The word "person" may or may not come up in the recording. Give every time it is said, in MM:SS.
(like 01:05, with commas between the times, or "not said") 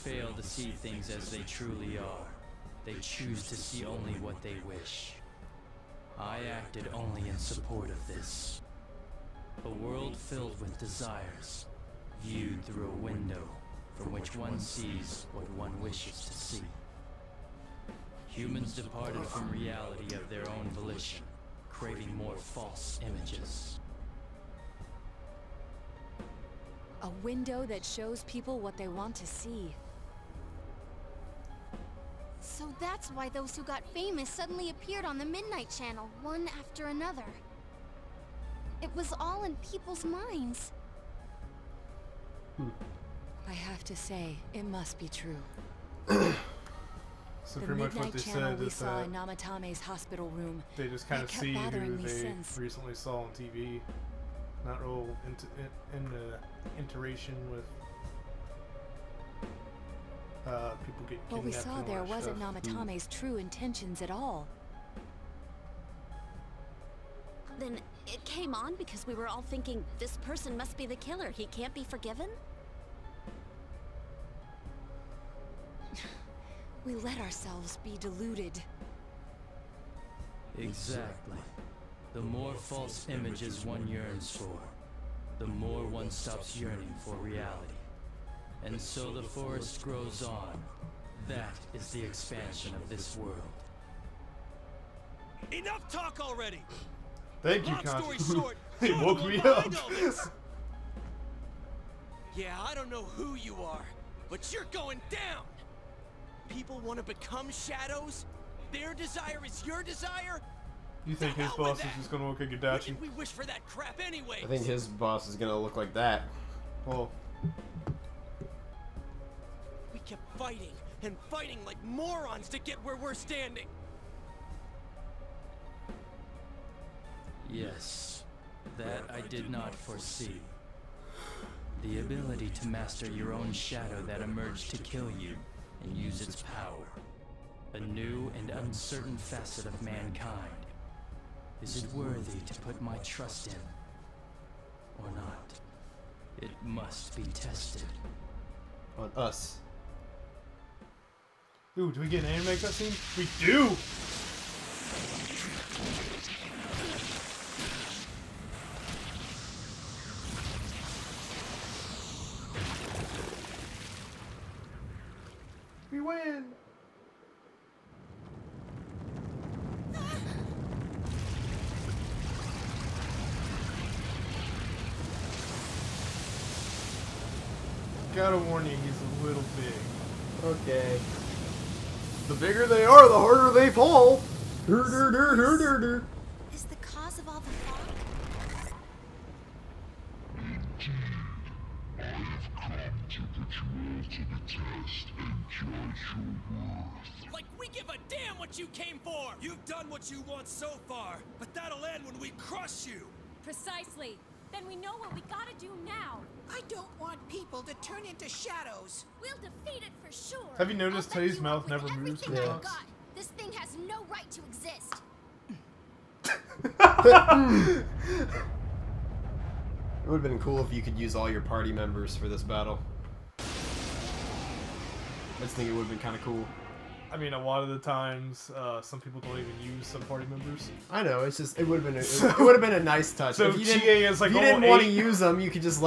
01:10.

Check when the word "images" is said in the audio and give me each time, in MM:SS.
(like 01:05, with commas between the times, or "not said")
00:23, 01:23.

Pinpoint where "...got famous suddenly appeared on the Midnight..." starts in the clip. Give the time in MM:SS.
00:33.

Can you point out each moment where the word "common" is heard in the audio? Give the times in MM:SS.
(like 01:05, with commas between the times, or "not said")
not said.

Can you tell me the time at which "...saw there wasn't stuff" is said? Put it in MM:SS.
01:01.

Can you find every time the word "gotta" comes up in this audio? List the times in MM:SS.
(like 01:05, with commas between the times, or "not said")
03:25.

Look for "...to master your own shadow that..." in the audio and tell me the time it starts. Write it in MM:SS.
02:12.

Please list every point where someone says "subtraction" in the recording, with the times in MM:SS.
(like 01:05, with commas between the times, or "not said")
not said.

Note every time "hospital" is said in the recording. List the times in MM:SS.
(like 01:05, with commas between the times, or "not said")
00:49.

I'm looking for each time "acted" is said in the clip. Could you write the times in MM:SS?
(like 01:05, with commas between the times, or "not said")
00:06.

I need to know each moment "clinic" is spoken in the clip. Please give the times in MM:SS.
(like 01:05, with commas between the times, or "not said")
not said.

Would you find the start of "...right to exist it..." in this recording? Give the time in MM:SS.
03:34.